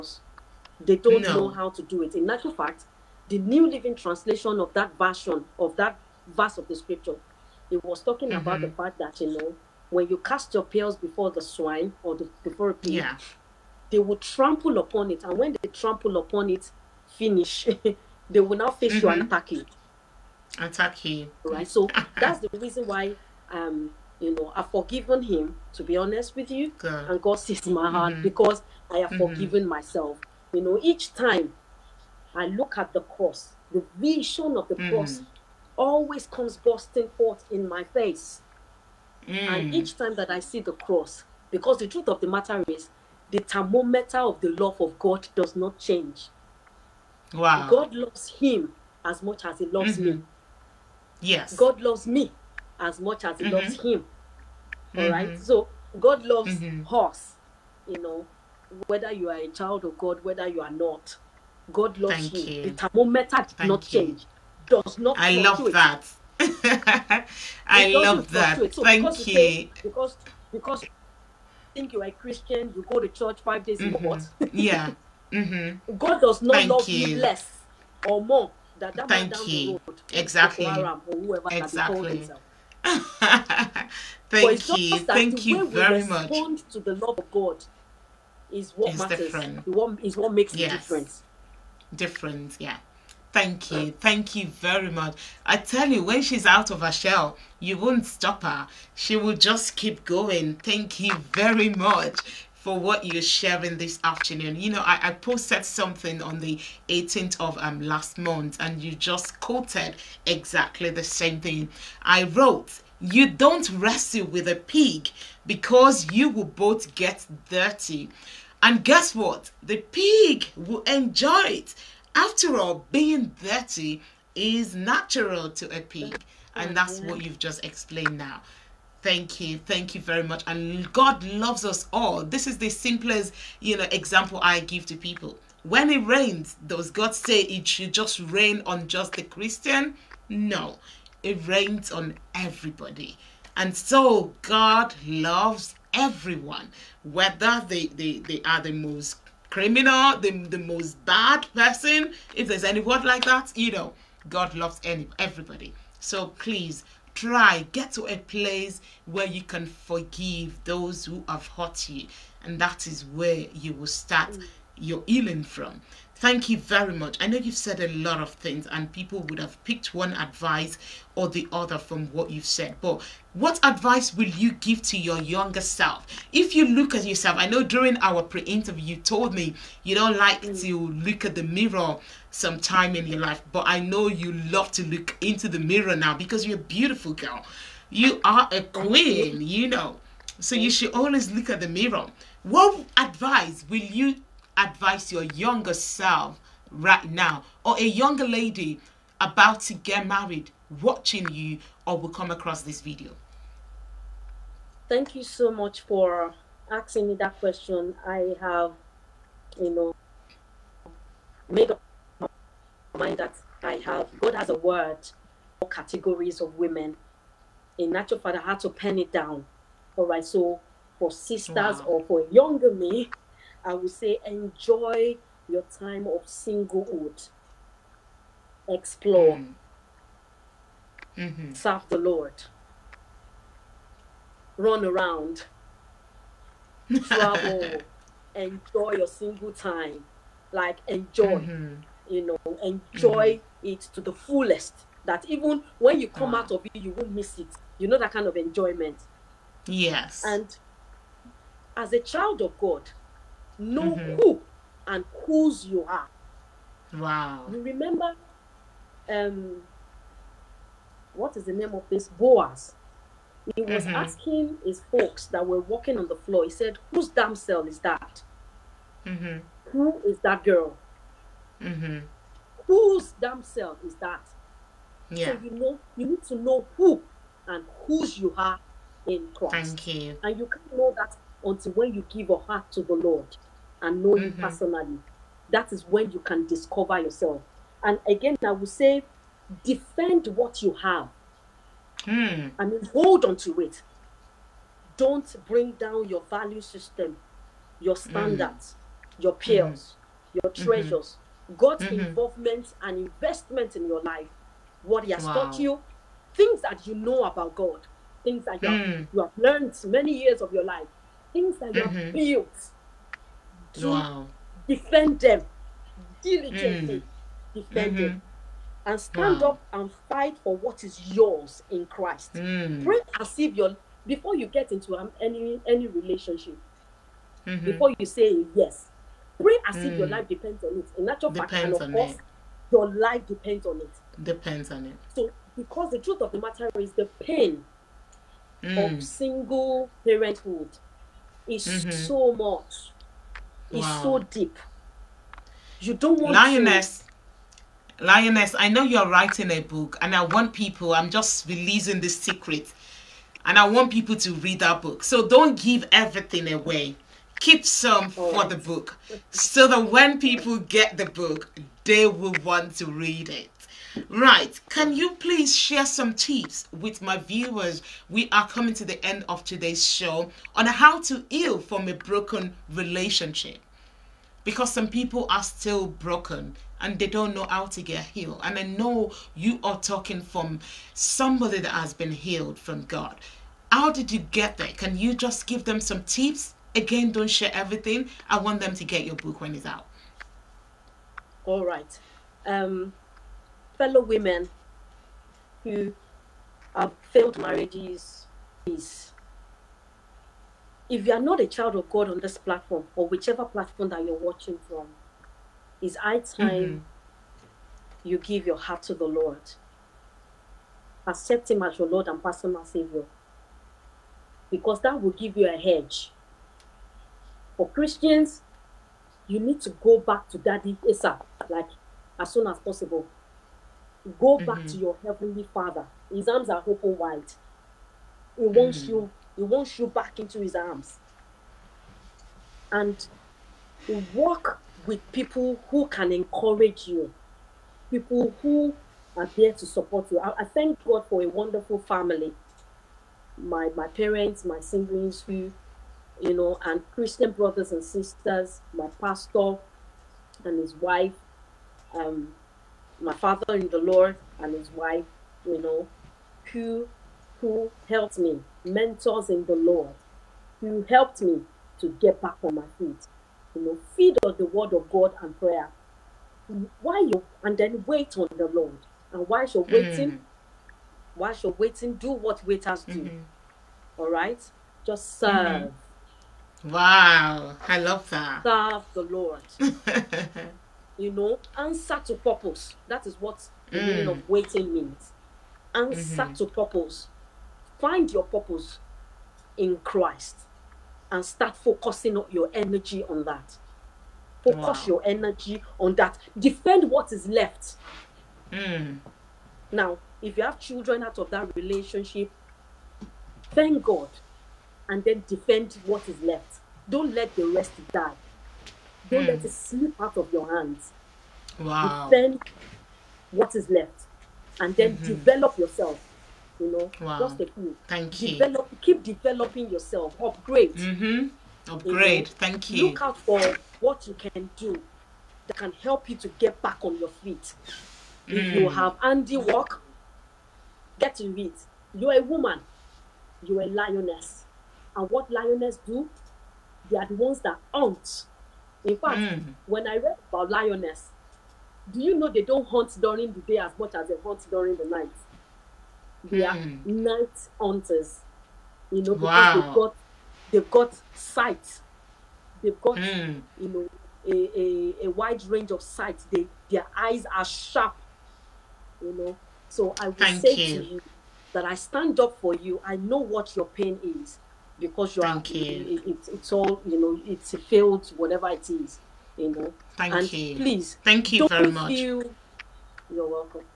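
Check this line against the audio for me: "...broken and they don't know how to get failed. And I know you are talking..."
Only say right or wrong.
wrong.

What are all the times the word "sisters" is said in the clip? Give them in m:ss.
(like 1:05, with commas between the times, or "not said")
3:41, 7:27.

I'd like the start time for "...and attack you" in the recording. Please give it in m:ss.
0:19.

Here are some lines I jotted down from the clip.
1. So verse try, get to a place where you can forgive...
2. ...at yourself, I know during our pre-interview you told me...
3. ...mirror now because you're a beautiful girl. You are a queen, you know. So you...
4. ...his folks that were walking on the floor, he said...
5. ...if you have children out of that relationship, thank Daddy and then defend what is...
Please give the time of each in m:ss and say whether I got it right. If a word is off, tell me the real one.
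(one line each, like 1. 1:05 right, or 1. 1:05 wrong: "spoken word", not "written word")
1. 2:35 wrong: "please", not "verse"
2. 2:56 right
3. 3:05 right
4. 4:24 right
5. 8:20 wrong: "God", not "Daddy".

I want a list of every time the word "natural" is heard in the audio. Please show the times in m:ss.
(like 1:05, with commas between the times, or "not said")
2:04, 3:37.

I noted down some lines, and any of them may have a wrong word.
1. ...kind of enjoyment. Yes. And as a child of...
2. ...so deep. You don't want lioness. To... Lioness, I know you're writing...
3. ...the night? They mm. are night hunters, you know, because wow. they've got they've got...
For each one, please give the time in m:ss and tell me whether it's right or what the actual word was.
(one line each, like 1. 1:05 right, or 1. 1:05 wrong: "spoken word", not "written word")
1. 4:08 right
2. 5:44 right
3. 9:04 right.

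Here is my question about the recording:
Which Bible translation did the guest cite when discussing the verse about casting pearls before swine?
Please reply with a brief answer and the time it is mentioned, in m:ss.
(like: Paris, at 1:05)
New Living Translation, at 0:03.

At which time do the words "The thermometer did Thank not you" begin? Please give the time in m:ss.
1:02.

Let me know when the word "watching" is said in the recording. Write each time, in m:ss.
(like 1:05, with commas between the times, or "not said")
3:20, 6:44.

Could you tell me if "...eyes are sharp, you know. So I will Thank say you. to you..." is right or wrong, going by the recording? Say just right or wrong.
right.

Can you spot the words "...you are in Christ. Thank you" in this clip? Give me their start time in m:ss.
4:38.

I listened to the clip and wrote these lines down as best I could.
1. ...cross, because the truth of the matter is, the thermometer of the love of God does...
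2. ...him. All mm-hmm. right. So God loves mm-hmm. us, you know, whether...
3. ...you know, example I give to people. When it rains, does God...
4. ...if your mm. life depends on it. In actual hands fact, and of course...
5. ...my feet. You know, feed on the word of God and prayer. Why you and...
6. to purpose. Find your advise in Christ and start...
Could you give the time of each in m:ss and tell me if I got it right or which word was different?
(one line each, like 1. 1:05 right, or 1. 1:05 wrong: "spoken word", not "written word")
1. 0:40 right
2. 0:53 right
3. 2:13 right
4. 5:29 wrong: "depends", not "hands"
5. 7:42 right
6. 8:06 wrong: "purpose", not "advise".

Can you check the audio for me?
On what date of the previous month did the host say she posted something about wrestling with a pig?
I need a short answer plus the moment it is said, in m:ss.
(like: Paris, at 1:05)
18th, at 1:46.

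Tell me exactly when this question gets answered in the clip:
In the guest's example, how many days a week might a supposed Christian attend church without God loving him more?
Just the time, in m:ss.
1:13.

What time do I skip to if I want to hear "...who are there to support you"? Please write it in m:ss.
7:18.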